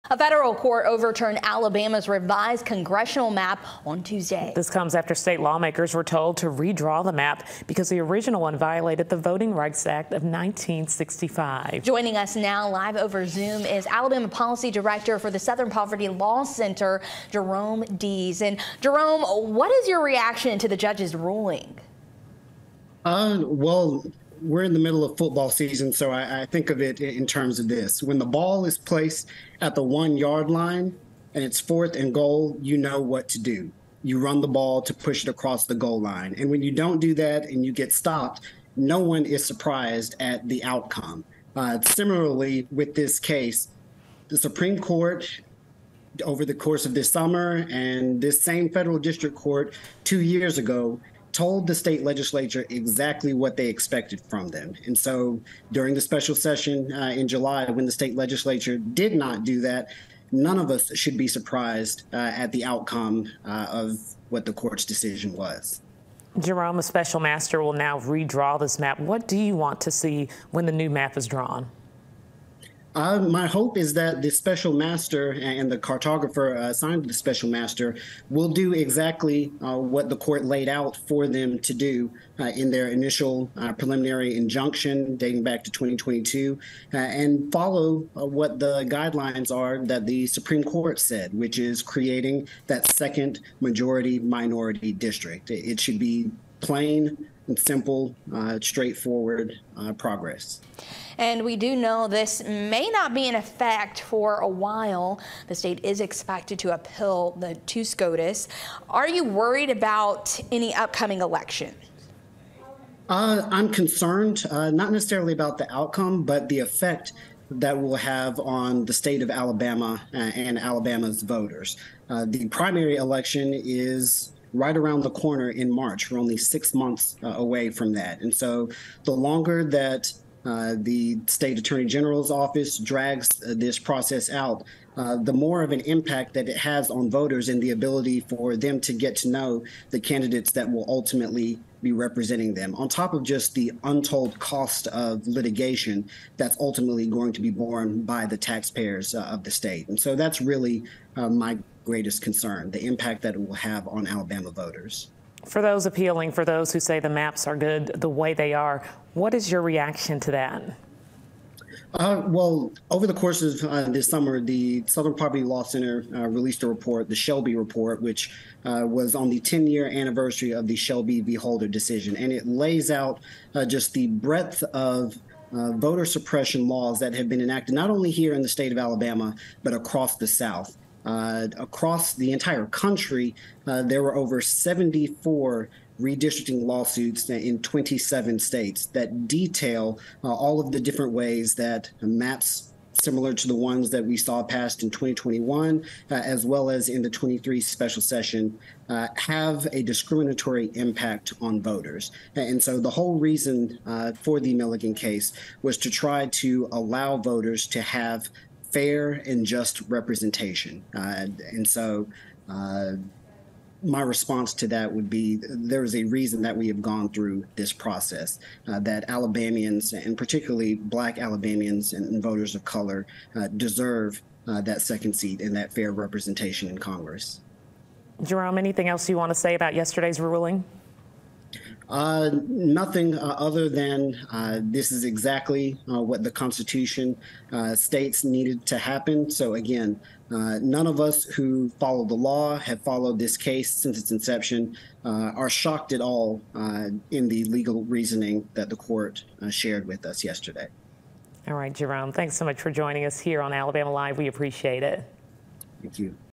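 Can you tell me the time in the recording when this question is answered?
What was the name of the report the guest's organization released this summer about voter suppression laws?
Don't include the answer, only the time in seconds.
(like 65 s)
167 s.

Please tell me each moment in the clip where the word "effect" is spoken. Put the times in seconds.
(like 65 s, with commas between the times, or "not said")
103 s, 116 s.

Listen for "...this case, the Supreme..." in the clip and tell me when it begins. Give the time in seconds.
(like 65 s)
42 s.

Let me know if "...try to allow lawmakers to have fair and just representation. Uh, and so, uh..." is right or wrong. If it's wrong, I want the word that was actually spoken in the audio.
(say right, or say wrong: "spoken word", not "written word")
wrong: "voters", not "lawmakers".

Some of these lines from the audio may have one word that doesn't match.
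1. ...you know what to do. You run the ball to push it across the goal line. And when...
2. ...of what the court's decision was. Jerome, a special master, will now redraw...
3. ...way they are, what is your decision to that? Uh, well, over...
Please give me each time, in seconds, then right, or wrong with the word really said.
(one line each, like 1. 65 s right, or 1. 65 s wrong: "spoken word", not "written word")
1. 32 s right
2. 63 s right
3. 158 s wrong: "reaction", not "decision".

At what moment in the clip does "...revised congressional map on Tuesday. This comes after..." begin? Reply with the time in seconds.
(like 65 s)
2 s.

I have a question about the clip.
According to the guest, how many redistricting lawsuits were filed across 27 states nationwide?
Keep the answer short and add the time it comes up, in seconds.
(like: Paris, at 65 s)
over 74, at 184 s.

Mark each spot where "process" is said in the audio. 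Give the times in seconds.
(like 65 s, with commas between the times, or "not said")
133 s, 217 s.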